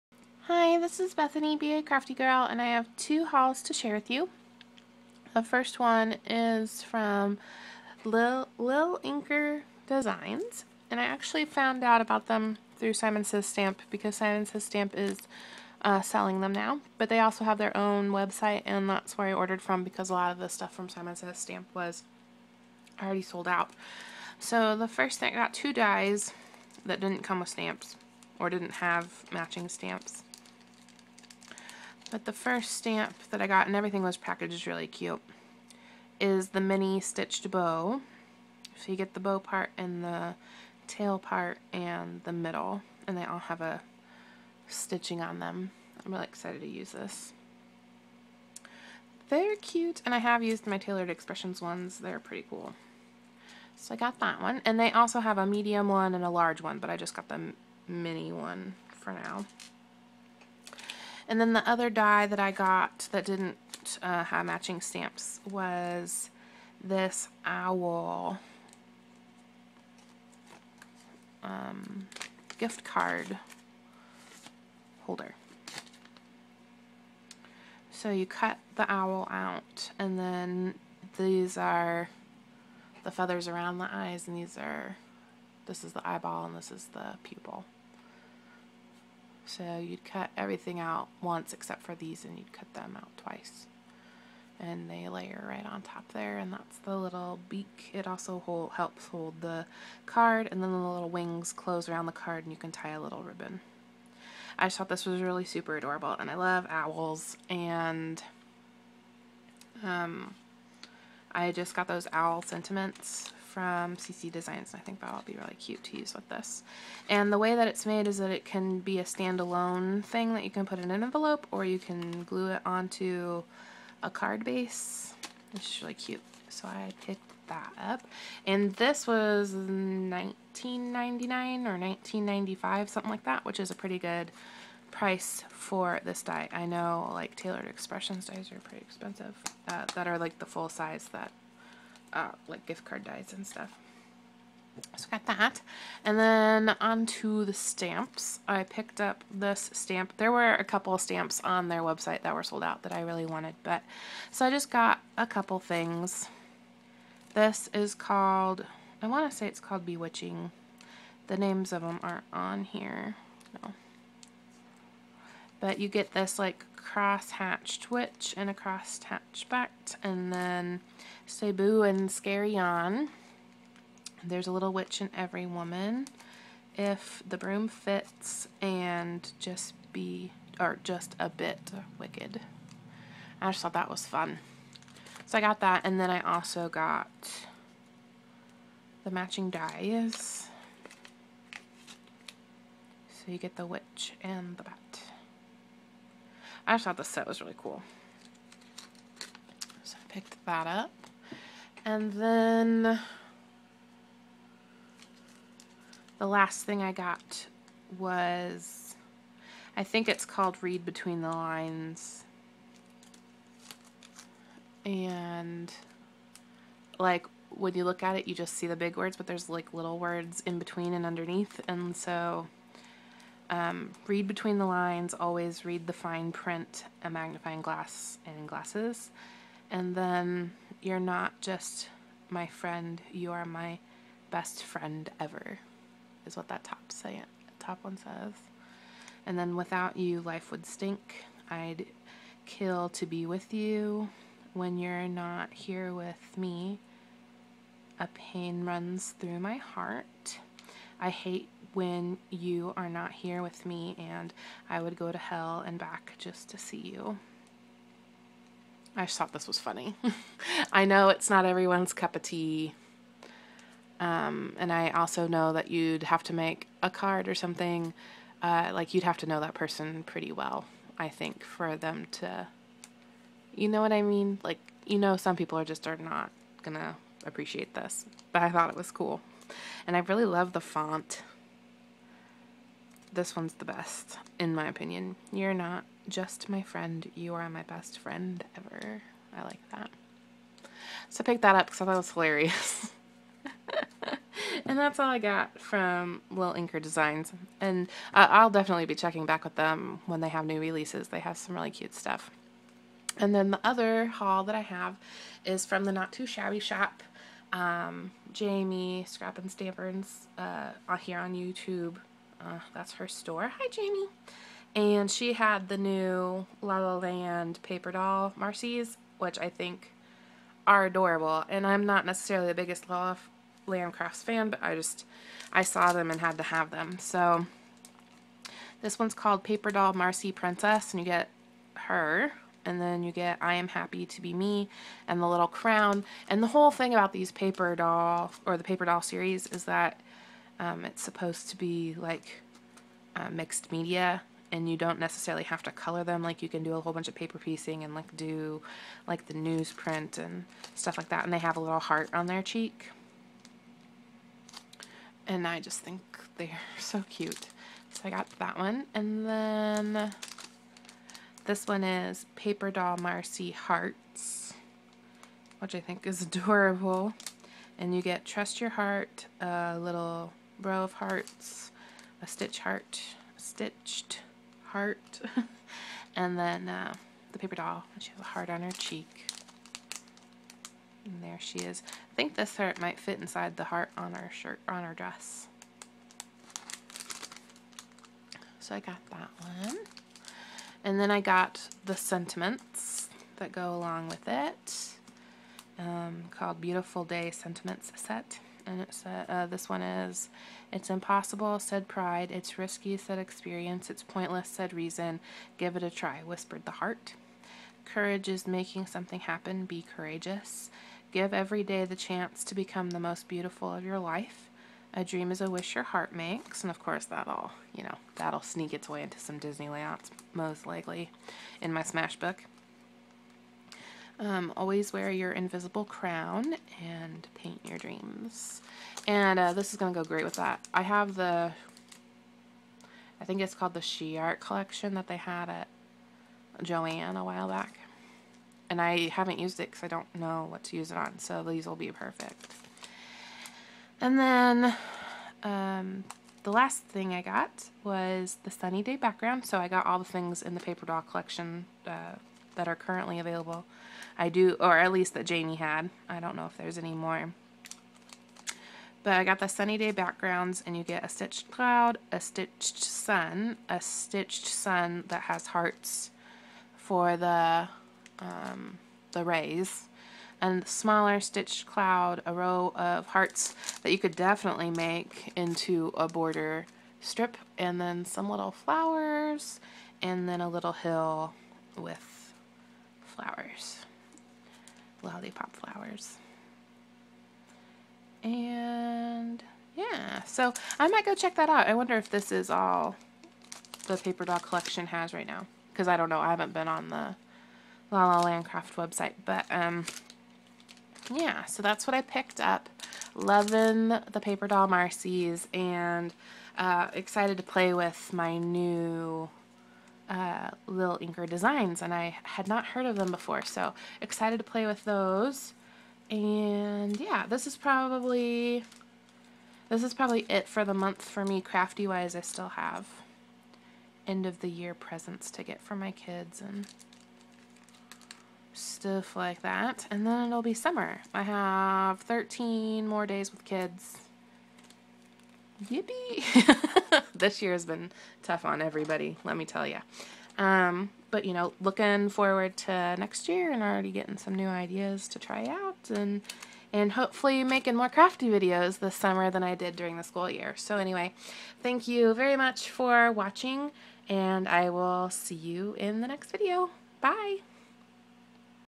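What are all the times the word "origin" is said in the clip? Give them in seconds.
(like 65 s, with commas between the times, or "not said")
not said.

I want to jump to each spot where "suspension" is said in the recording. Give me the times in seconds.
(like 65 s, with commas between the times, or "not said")
not said.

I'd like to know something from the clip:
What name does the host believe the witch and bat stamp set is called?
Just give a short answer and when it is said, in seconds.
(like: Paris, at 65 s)
Bewitching, at 159 s.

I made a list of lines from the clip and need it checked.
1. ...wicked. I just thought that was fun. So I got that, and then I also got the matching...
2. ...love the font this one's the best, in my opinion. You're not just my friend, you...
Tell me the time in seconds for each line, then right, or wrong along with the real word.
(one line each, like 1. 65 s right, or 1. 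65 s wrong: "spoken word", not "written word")
1. 181 s right
2. 280 s right.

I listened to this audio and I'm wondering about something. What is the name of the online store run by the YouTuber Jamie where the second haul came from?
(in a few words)
Not Too Shabby.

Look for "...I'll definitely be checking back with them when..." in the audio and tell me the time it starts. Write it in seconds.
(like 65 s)
298 s.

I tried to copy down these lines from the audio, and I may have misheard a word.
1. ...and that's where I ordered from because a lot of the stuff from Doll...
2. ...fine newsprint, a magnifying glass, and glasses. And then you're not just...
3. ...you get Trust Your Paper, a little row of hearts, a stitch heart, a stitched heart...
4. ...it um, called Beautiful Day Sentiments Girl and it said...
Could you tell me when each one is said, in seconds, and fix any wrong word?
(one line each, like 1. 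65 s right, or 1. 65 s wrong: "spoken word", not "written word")
1. 18 s wrong: "Simon", not "Doll"
2. 225 s wrong: "print", not "newsprint"
3. 367 s wrong: "Heart", not "Paper"
4. 394 s wrong: "Set", not "Girl".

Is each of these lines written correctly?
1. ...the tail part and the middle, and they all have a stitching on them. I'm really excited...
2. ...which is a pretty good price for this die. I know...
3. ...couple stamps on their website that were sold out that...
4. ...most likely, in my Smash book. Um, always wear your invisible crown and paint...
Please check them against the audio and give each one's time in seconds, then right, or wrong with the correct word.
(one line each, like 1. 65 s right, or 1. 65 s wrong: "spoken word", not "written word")
1. 40 s right
2. 133 s right
3. 150 s right
4. 420 s right.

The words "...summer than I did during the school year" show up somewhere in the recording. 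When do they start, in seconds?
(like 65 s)
548 s.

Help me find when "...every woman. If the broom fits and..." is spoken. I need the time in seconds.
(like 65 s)
175 s.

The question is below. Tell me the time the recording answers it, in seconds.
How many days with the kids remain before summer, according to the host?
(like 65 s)
532 s.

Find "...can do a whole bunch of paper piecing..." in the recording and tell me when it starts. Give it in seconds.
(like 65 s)
346 s.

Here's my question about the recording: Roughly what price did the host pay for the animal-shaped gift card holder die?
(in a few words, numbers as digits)
$19.99.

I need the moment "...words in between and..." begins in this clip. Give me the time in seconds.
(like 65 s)
219 s.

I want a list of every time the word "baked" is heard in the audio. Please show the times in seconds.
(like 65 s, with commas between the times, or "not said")
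not said.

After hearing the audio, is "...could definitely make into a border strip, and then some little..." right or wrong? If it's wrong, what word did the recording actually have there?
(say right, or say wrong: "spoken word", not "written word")
right.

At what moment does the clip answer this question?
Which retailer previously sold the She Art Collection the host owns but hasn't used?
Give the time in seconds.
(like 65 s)
436 s.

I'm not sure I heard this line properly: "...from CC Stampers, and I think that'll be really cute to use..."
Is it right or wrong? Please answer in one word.
wrong.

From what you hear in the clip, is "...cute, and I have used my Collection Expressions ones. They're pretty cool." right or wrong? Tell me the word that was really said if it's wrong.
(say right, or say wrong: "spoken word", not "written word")
wrong: "Taylored", not "Collection".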